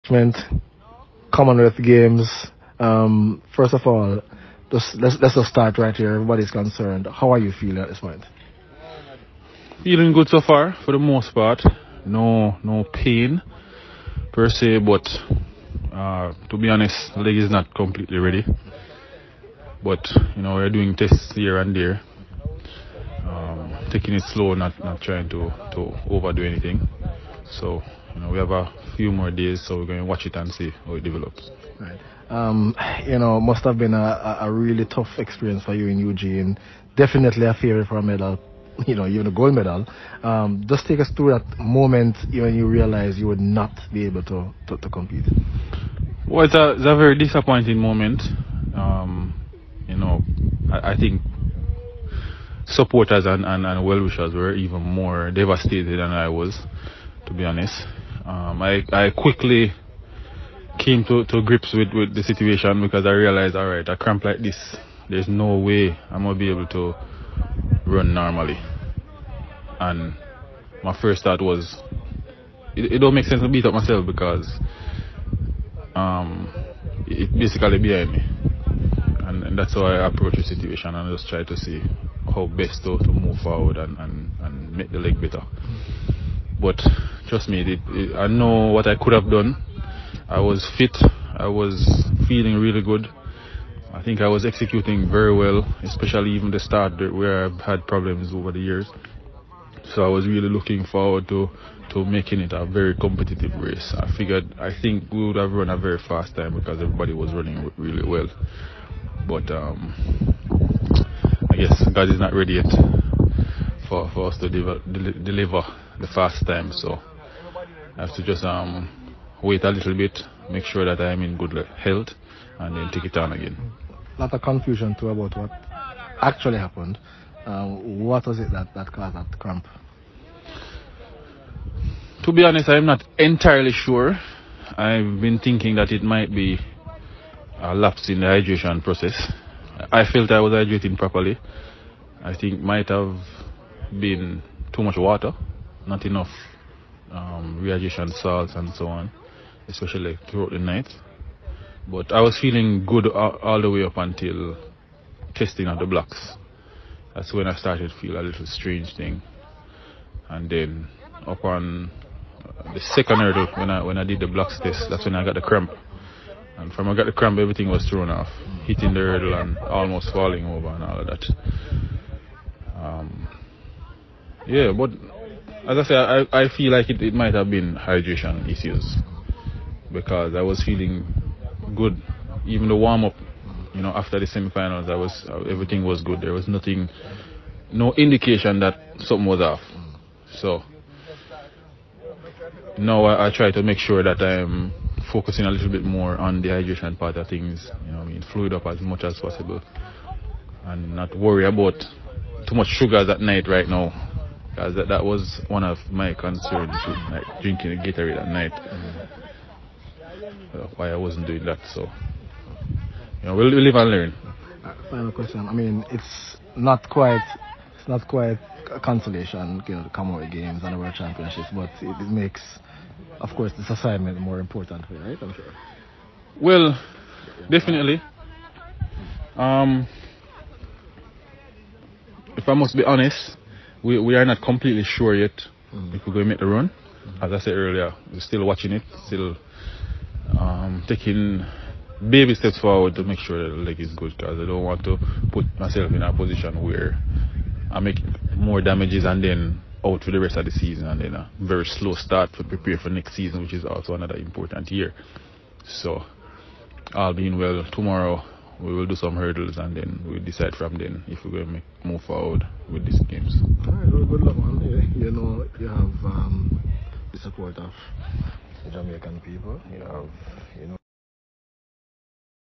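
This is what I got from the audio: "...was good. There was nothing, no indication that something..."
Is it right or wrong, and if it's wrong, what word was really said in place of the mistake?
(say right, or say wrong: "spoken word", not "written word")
right.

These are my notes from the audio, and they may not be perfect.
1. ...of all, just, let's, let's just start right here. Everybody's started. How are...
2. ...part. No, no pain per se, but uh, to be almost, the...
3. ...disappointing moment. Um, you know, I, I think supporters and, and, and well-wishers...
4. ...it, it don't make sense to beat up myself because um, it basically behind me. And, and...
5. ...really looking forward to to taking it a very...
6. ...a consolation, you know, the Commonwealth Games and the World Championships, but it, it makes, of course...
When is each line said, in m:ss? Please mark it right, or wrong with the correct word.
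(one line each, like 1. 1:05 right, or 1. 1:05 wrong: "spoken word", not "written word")
1. 0:03 wrong: "concerned", not "started"
2. 0:11 wrong: "honest", not "almost"
3. 0:47 right
4. 1:12 right
5. 1:40 wrong: "making", not "taking"
6. 3:38 right.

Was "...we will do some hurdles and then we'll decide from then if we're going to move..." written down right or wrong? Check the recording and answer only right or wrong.
right.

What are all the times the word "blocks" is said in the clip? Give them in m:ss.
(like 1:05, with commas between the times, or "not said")
2:35, 2:44.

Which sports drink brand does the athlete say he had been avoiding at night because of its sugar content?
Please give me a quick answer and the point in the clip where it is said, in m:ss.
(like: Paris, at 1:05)
Gatorade, at 3:27.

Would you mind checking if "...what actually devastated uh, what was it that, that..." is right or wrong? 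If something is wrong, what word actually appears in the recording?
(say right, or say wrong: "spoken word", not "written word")
wrong: "happened", not "devastated".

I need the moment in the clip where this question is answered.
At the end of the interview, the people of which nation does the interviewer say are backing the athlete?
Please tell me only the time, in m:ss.
4:28.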